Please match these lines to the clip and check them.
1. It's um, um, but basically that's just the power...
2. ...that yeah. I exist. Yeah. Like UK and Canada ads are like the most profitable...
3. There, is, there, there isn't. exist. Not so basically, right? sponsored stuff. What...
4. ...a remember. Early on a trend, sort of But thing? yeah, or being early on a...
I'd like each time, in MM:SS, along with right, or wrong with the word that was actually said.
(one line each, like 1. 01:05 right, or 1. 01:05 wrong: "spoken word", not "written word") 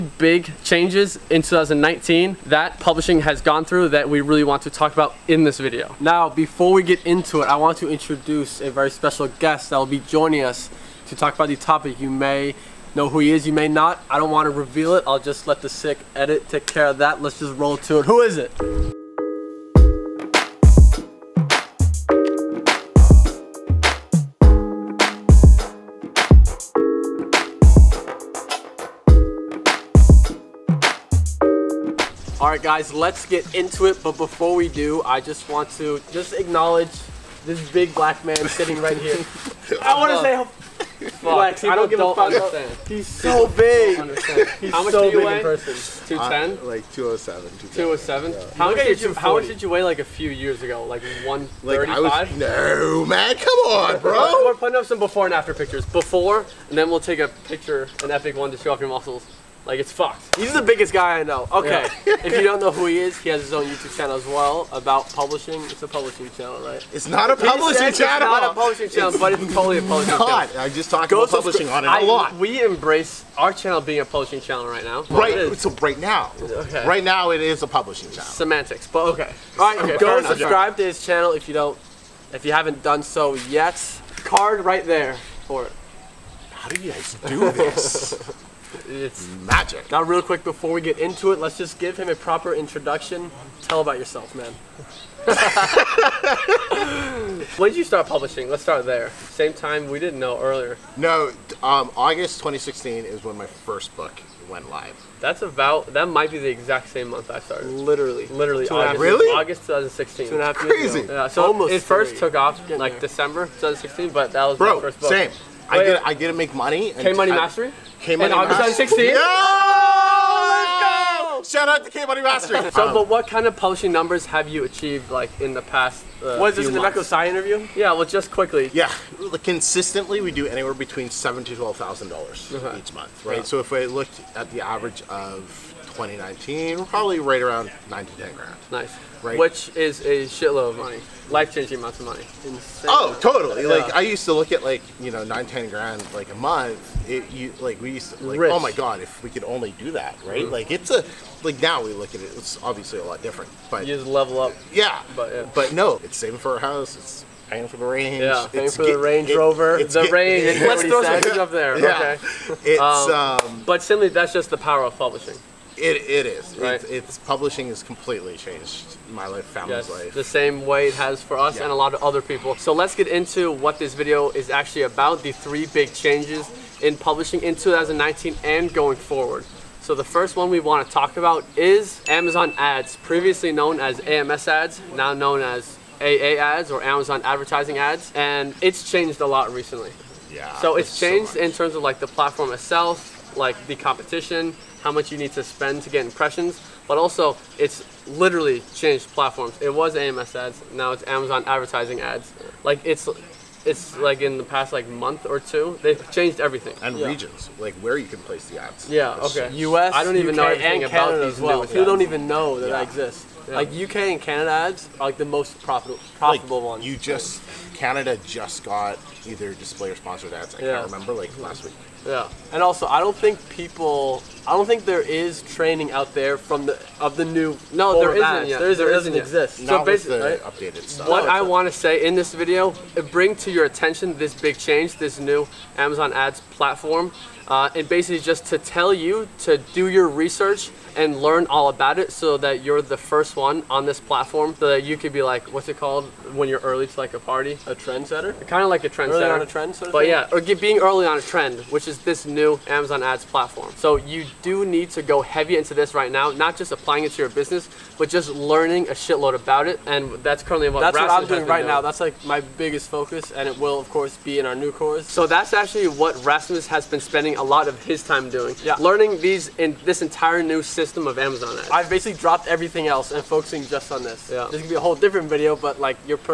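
1. 02:42 wrong: "simply", not "basically"
2. 03:32 right
3. 03:48 wrong: "updated", not "sponsored"
4. 04:08 wrong: "trendsetter", not "remember".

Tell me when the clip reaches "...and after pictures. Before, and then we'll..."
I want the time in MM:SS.
00:55.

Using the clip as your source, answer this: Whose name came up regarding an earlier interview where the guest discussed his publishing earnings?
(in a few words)
Emeka Ossai.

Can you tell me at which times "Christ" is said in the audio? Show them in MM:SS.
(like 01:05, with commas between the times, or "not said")
not said.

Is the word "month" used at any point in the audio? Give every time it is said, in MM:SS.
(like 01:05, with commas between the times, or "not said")
01:47, 02:12, 02:26, 03:24.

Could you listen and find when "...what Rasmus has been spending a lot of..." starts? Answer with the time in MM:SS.
04:25.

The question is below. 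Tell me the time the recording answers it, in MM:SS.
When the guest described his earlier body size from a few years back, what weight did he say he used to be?
00:51.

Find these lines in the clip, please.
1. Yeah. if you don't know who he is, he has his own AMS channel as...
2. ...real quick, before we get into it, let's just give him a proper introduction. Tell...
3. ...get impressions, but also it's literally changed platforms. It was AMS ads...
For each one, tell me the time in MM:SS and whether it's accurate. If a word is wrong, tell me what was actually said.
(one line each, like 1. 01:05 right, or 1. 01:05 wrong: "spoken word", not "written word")
1. 01:02 wrong: "YouTube", not "AMS"
2. 01:30 right
3. 03:15 right.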